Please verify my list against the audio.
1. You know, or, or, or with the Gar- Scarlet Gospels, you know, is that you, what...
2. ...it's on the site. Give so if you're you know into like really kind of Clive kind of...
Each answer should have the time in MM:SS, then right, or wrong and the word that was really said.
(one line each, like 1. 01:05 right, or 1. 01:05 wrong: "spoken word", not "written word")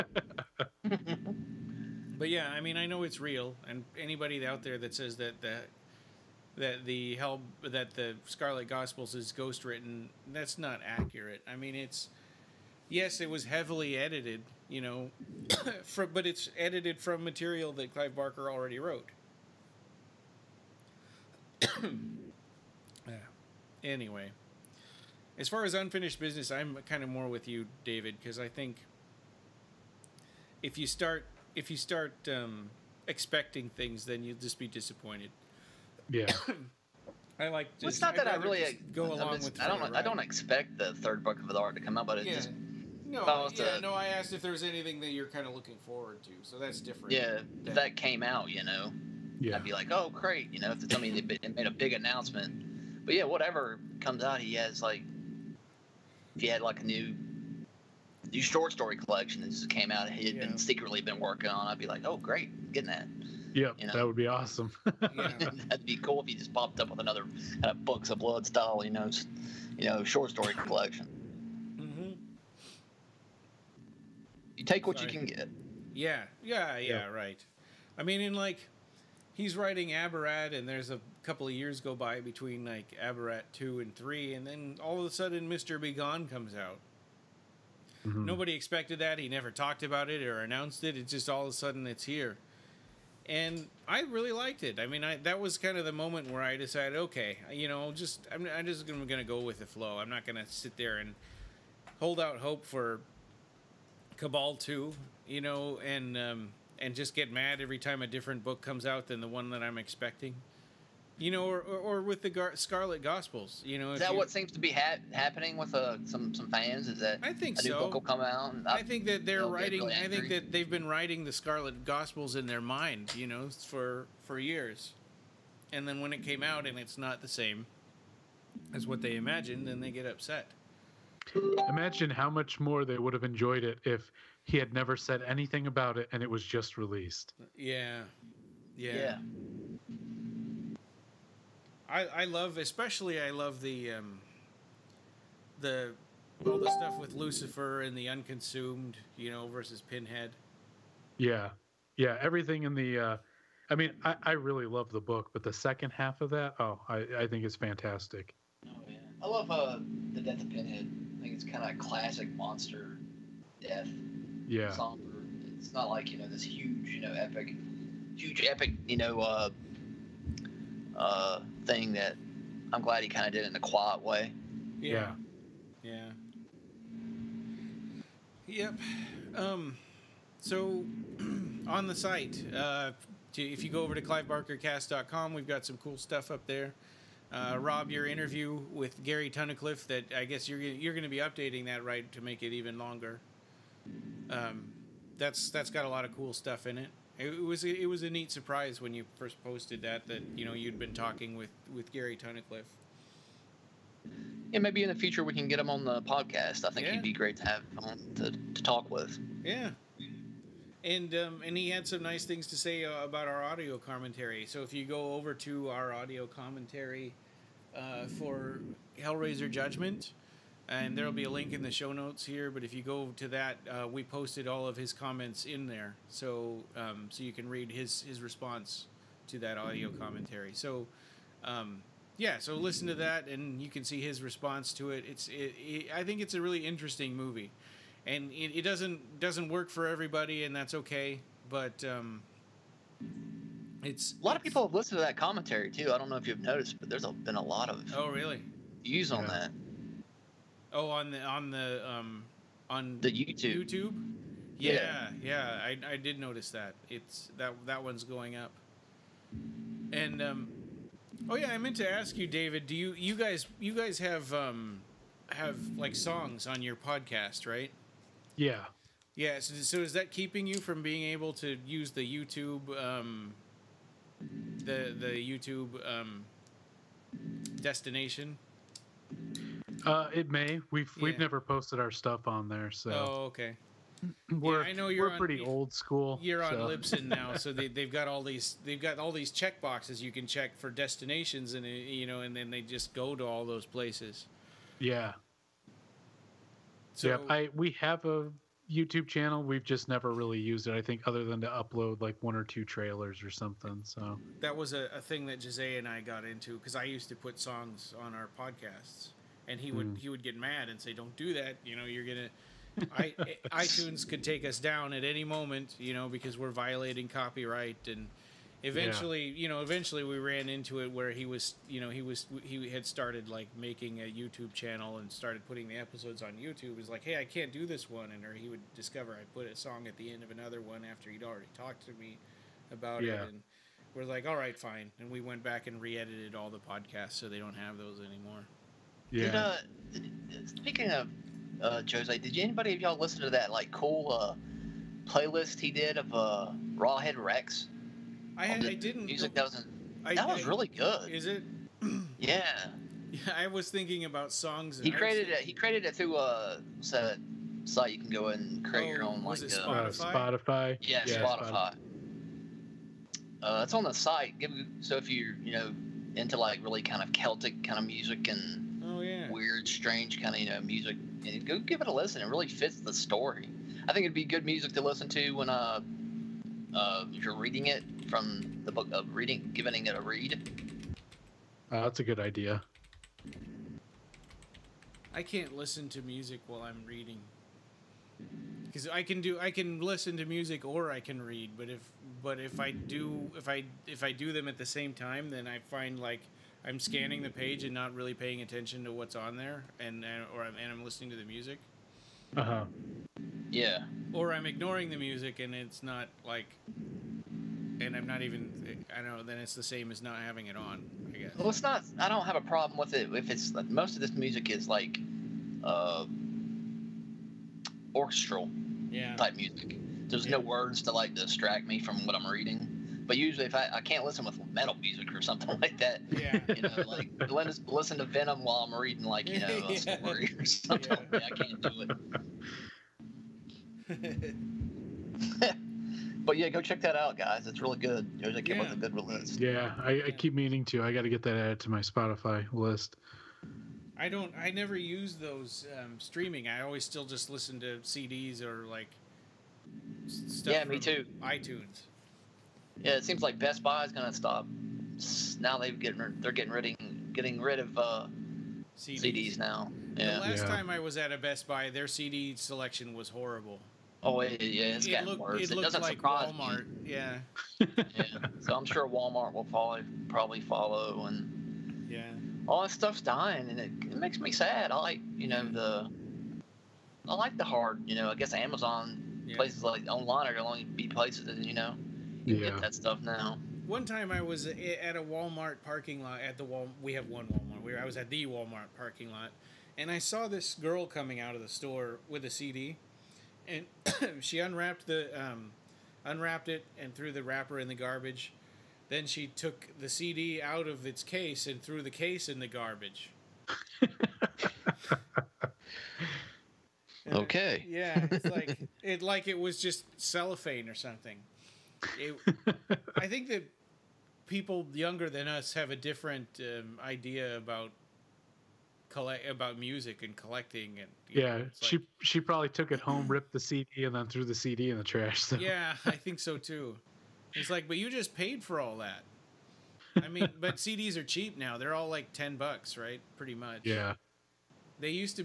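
1. 01:51 right
2. 06:03 wrong: "Celtic", not "Clive".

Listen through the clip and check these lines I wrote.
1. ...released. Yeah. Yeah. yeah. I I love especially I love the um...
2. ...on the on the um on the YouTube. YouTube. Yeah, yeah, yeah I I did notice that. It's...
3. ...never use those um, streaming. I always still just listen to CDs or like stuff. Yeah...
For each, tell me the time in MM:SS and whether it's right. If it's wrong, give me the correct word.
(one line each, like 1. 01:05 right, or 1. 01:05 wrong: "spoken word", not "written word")
1. 02:16 right
2. 04:10 right
3. 07:24 right.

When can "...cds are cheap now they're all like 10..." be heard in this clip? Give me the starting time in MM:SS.
08:50.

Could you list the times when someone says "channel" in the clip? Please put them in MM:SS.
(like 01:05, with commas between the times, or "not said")
04:59, 05:24.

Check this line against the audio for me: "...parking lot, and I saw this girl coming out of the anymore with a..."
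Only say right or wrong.
wrong.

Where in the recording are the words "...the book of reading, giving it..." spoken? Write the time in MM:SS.
06:18.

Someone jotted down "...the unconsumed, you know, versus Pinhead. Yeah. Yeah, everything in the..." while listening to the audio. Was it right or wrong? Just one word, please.
right.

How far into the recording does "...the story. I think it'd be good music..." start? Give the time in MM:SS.
06:12.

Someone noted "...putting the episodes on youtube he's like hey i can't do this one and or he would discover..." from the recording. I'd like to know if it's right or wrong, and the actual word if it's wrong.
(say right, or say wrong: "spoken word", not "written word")
right.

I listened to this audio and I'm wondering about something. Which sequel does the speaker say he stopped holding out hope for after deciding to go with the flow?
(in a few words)
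Cabal 2.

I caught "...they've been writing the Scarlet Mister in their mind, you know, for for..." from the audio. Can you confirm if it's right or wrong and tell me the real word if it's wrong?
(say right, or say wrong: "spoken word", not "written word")
wrong: "Gospels", not "Mister".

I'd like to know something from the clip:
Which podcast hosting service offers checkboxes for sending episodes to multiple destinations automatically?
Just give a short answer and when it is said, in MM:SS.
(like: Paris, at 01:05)
Libsyn, at 04:46.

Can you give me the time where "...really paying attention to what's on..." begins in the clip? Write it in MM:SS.
06:37.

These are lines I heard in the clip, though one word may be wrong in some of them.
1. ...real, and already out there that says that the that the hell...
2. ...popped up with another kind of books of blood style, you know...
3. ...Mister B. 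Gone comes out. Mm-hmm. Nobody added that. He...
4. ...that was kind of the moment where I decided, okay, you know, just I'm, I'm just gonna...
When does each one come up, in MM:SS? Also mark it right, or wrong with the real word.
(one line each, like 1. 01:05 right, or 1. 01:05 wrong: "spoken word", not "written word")
1. 00:03 wrong: "anybody", not "already"
2. 01:06 right
3. 01:25 wrong: "expected", not "added"
4. 01:35 right.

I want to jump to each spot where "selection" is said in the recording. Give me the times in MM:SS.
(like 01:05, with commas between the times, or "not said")
07:42.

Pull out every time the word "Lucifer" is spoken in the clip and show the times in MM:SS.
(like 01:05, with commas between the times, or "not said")
02:27.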